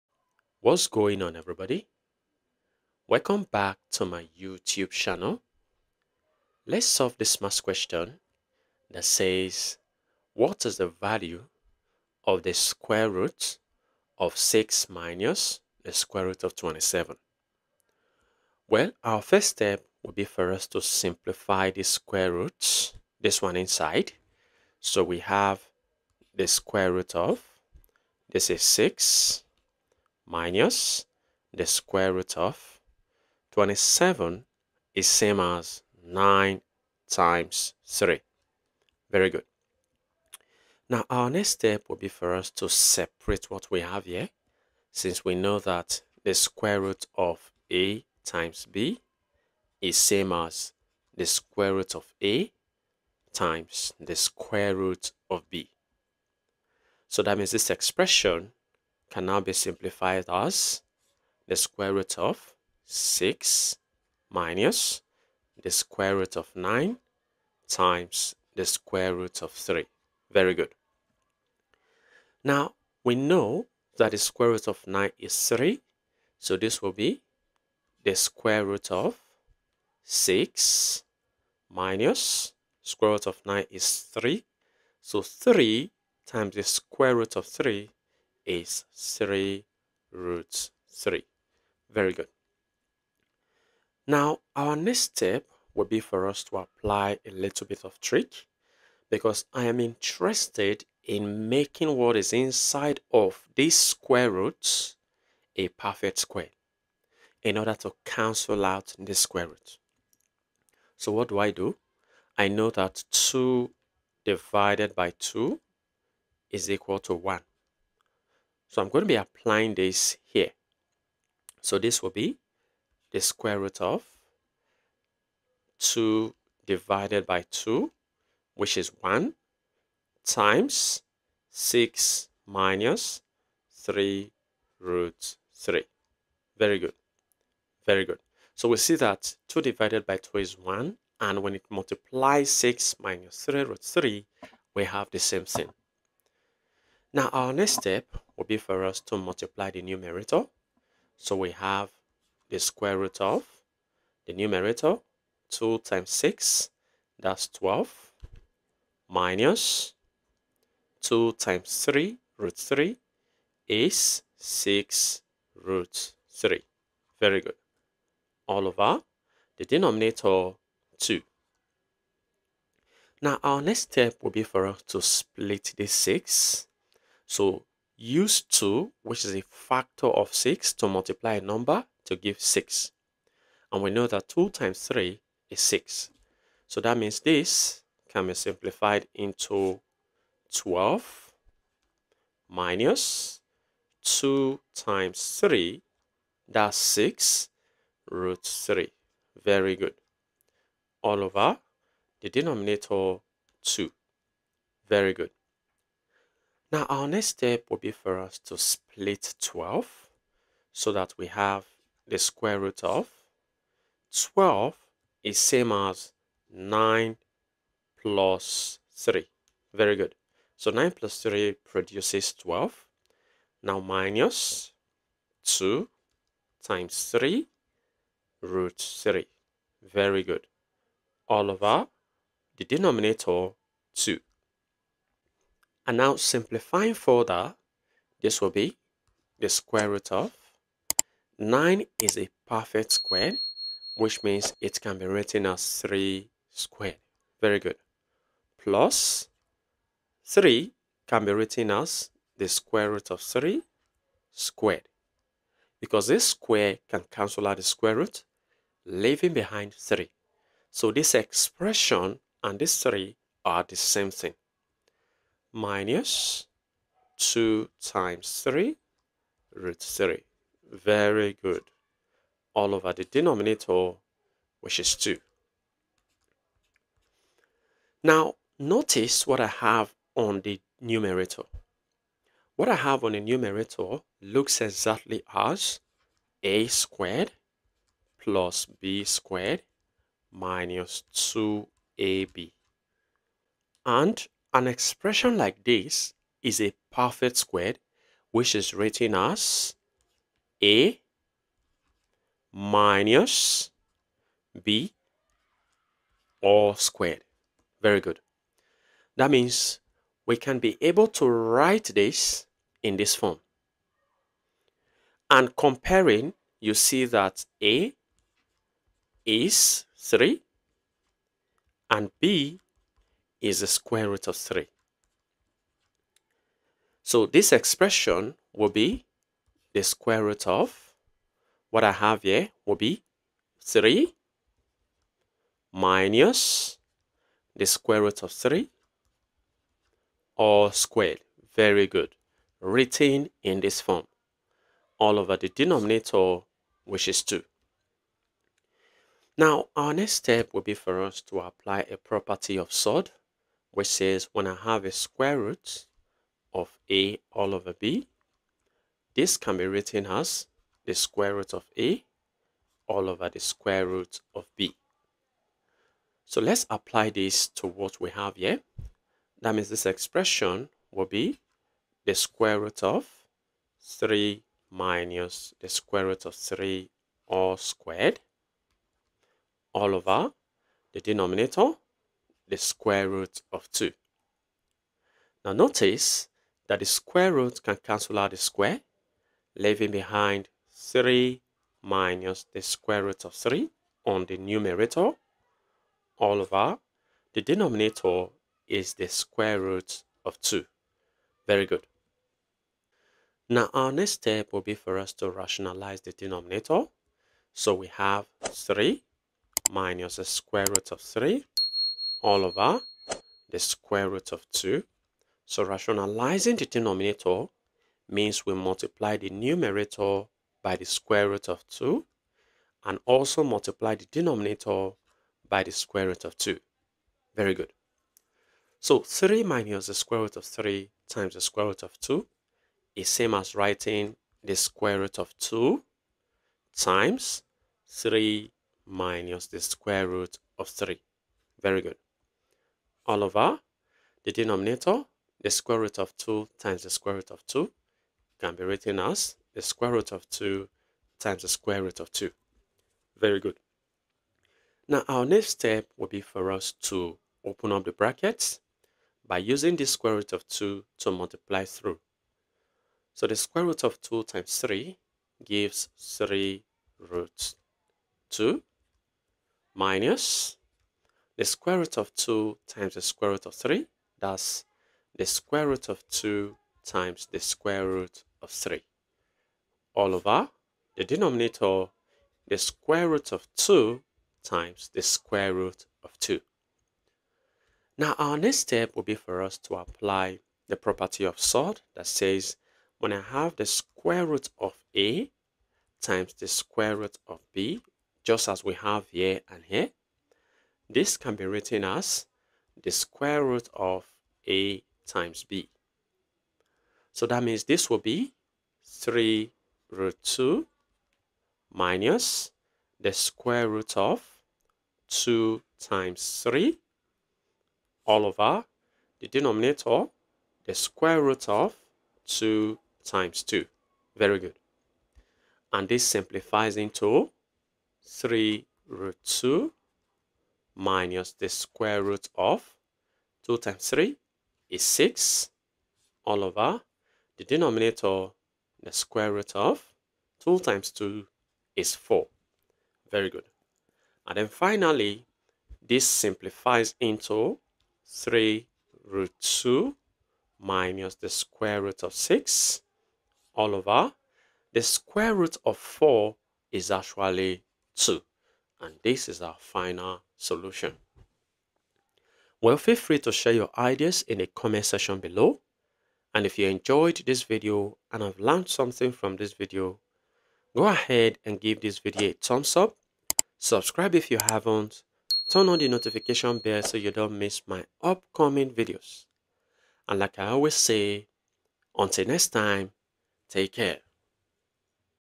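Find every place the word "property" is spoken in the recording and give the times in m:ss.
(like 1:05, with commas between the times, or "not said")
5:51, 8:10.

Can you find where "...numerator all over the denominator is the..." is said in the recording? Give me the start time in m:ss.
6:34.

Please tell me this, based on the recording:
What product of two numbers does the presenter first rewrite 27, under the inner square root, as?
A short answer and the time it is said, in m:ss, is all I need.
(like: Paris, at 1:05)
9 times 3, at 0:36.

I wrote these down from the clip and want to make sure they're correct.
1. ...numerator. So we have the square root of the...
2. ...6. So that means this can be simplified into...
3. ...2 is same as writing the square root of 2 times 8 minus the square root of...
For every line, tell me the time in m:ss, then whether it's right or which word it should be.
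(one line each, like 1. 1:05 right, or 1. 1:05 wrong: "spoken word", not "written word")
1. 2:29 right
2. 3:05 right
3. 7:11 wrong: "3", not "8".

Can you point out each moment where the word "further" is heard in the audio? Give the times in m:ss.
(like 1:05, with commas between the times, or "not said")
3:56.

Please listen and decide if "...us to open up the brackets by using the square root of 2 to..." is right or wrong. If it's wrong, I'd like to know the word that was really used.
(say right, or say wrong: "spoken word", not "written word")
right.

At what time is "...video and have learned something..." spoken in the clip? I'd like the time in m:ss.
9:27.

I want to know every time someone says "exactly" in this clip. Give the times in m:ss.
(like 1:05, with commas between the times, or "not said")
4:44.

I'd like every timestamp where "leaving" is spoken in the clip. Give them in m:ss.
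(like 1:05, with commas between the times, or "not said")
4:18, 6:29.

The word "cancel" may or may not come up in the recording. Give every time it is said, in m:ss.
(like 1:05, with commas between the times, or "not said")
1:48, 4:17, 6:27.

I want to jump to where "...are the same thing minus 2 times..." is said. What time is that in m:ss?
4:23.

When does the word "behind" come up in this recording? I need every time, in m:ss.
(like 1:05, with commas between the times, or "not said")
4:19, 6:29.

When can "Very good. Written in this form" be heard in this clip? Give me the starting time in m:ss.
5:41.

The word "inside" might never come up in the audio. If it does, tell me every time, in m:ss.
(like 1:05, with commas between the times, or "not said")
0:23, 1:42.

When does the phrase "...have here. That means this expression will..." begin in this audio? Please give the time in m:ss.
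6:08.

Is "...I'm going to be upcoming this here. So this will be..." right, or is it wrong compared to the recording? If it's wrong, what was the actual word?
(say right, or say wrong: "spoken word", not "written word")
wrong: "applying", not "upcoming".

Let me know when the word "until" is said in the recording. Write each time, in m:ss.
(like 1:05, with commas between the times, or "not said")
9:41.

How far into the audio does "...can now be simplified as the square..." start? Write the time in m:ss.
0:59.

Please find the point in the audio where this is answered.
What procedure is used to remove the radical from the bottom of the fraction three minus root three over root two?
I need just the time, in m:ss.
6:45.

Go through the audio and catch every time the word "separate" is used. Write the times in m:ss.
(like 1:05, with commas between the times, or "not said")
0:42.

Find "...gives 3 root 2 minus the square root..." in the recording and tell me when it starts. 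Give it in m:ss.
7:45.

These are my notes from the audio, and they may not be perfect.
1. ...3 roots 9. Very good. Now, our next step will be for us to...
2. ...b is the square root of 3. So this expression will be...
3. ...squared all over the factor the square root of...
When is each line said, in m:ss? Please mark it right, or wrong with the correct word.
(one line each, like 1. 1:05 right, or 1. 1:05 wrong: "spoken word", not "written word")
1. 1:28 wrong: "3", not "9"
2. 5:22 right
3. 6:17 wrong: "denominator", not "factor".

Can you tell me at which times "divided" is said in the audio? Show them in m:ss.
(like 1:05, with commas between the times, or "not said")
1:54, 2:06, 2:19.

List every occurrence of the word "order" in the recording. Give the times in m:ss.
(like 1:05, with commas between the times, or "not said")
1:47.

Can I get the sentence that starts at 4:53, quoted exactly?
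And an expression like this is a perfect square, which is written as a minus b all squared.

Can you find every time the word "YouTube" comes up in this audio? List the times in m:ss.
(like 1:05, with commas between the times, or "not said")
0:04.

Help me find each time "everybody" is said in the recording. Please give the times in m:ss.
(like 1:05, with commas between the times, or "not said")
0:01.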